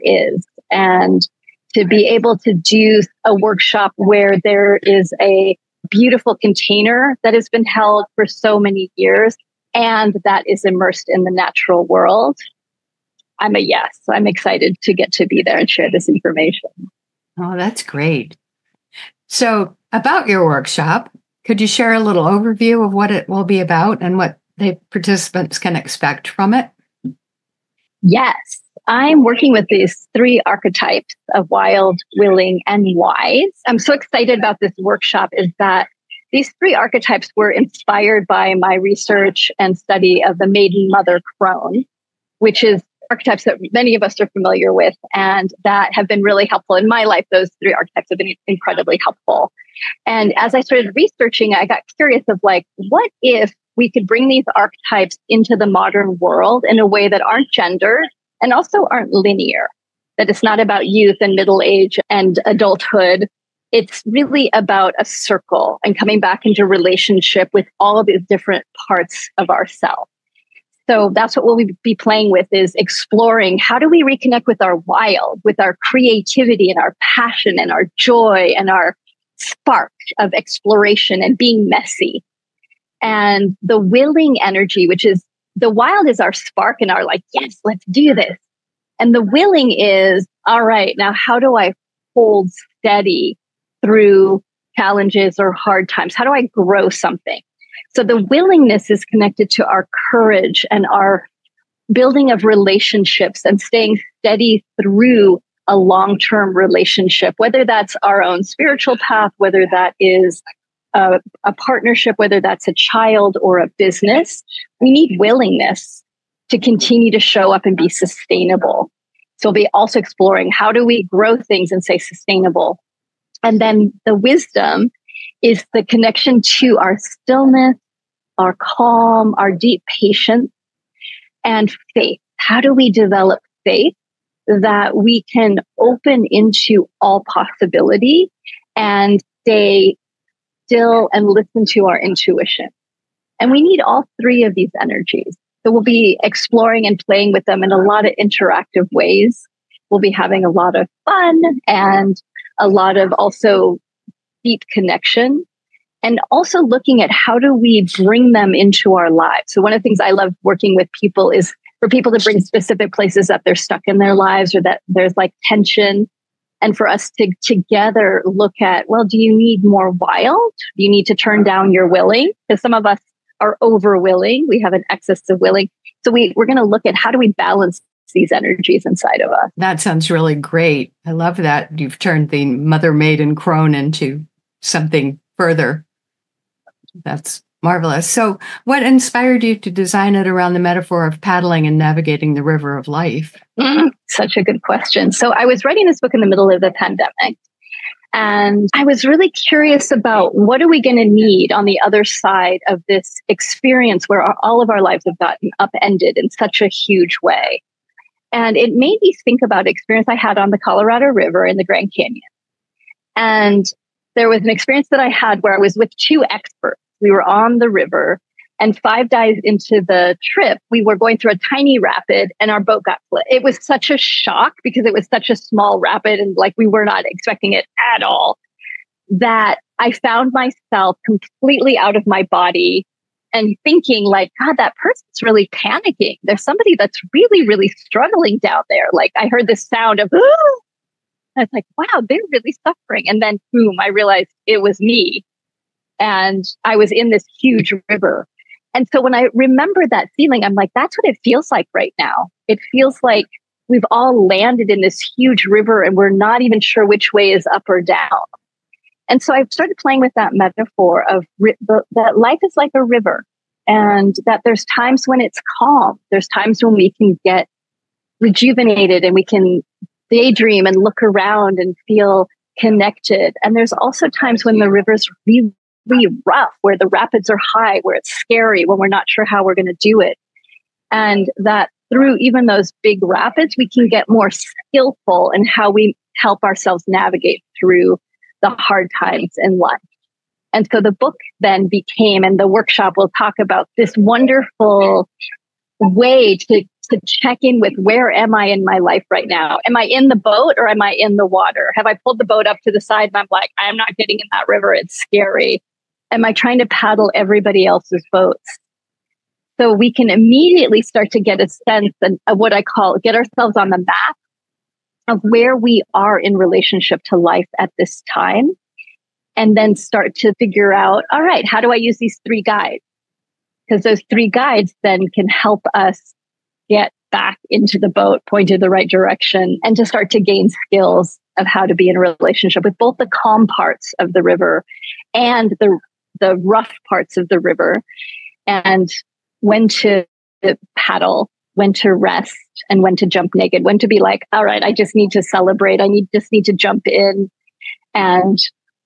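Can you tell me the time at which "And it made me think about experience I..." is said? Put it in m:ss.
3:28.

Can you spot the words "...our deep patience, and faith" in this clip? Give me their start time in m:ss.
2:09.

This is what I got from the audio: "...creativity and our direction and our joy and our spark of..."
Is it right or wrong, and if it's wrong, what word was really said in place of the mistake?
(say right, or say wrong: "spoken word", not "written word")
wrong: "passion", not "direction".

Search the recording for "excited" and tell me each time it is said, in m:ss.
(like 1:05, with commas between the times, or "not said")
0:14, 0:33.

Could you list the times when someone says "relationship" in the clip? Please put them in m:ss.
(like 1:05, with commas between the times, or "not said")
1:06, 1:42, 1:46, 5:16, 5:31.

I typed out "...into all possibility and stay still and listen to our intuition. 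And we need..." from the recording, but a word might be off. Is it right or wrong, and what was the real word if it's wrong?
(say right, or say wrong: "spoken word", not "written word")
right.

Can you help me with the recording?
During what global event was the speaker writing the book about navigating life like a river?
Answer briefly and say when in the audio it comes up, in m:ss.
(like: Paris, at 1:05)
The pandemic, at 3:16.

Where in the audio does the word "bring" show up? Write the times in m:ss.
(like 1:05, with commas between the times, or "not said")
0:54, 2:37, 2:42.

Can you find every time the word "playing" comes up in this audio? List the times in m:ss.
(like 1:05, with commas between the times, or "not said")
1:11, 2:27, 4:19.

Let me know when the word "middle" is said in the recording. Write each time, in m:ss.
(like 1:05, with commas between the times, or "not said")
1:01, 3:16.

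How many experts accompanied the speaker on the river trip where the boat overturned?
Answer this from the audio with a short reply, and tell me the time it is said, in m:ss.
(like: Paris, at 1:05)
2, at 3:35.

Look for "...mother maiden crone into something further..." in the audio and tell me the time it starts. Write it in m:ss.
3:02.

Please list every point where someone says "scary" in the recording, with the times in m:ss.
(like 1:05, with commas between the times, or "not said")
4:38, 5:04.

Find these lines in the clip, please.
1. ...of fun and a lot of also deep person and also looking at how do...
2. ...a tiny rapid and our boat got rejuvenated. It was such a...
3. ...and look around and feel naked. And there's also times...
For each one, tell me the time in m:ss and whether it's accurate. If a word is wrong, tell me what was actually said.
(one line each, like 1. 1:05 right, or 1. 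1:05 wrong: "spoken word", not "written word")
1. 2:30 wrong: "connection", not "person"
2. 3:41 wrong: "flipped", not "rejuvenated"
3. 4:30 wrong: "connected", not "naked".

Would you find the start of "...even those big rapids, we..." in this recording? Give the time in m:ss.
4:42.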